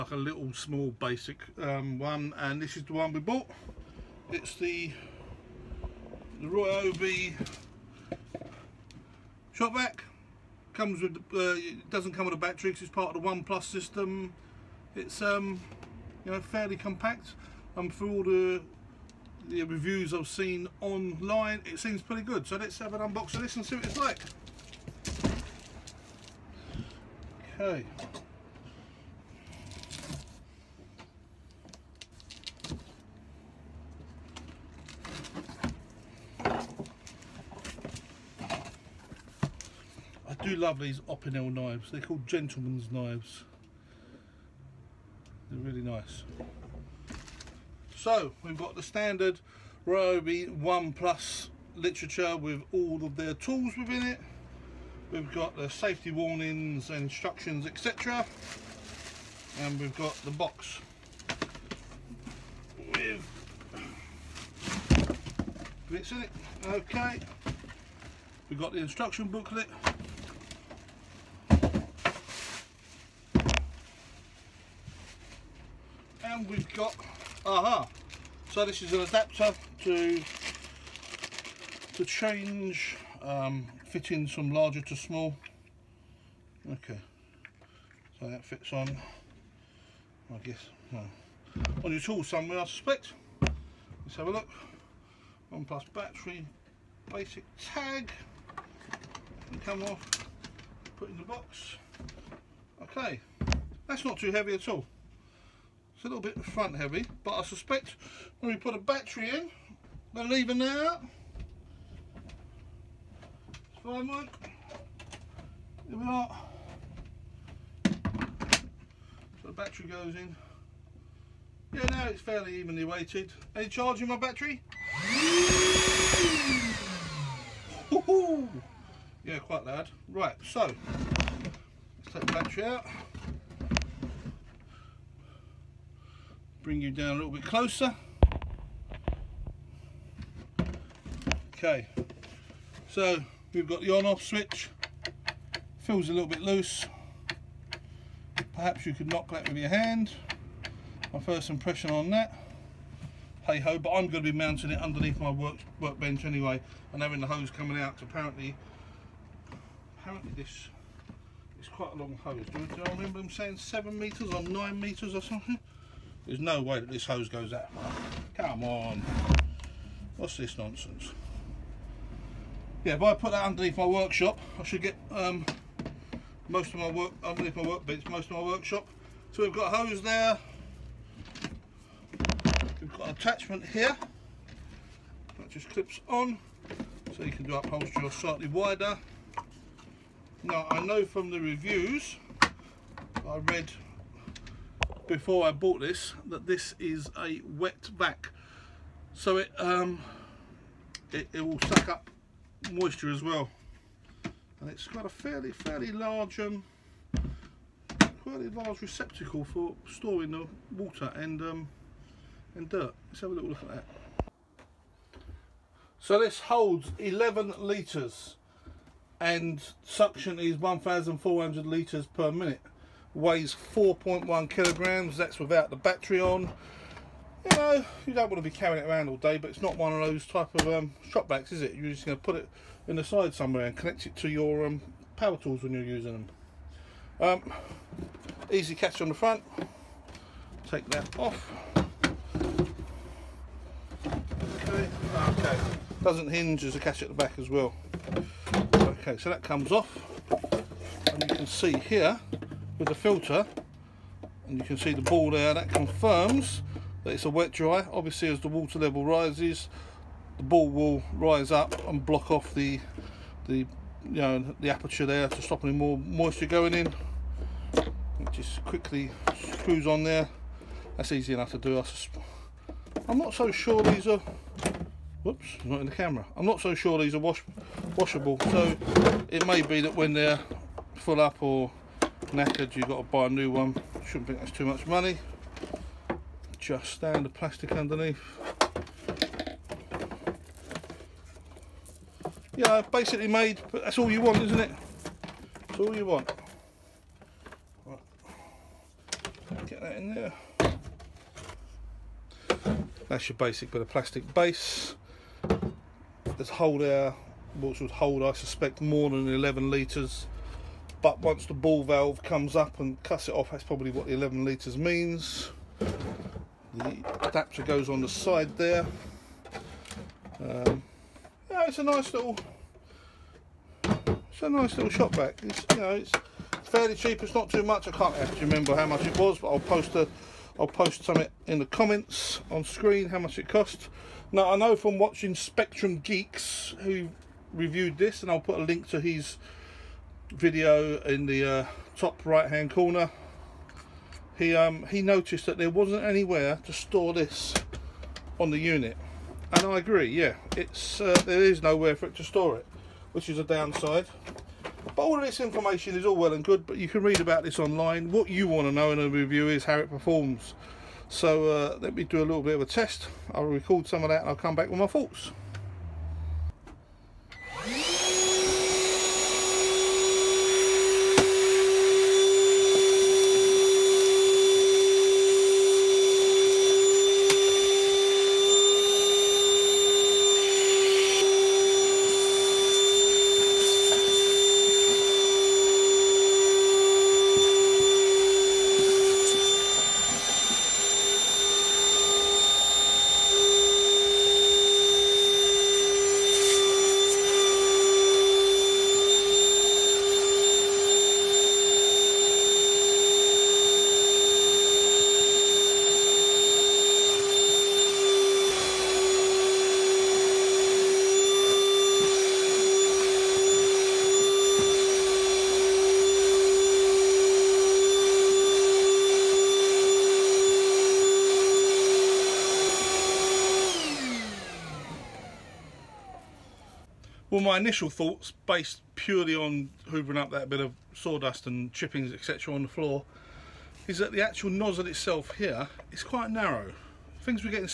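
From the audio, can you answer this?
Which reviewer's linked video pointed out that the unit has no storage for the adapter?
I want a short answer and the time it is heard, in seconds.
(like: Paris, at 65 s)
Spectrum Geeks, at 335 s.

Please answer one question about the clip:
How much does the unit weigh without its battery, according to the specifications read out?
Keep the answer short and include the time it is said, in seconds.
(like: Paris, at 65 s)
4.1 kilograms, at 223 s.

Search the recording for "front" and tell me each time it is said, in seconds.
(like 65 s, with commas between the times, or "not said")
106 s, 239 s.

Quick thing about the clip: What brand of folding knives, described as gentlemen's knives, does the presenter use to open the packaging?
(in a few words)
Opinel.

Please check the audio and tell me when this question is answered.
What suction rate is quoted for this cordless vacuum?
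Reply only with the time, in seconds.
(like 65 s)
220 s.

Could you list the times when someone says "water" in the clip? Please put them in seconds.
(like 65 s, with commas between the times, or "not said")
210 s, 258 s.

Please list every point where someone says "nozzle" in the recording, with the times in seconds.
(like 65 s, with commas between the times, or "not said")
434 s.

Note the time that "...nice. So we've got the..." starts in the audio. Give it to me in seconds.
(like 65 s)
45 s.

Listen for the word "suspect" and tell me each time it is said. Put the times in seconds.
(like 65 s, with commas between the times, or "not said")
92 s, 107 s, 308 s.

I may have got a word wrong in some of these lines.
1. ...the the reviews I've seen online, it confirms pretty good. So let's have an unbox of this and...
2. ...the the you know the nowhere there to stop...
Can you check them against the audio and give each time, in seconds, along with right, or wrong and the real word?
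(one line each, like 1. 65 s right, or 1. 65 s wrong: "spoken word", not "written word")
1. 18 s wrong: "seems", not "confirms"
2. 262 s wrong: "aperture", not "nowhere".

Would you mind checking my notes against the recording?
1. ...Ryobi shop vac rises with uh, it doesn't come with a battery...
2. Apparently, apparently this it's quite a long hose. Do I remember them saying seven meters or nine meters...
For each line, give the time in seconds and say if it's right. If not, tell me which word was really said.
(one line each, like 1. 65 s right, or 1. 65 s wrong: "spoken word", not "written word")
1. 6 s wrong: "comes", not "rises"
2. 158 s right.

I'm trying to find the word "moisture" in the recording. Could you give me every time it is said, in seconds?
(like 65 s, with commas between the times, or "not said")
202 s, 265 s.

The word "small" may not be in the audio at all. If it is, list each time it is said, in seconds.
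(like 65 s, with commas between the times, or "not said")
0 s, 84 s.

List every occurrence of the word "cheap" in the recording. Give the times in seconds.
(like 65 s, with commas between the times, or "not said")
326 s.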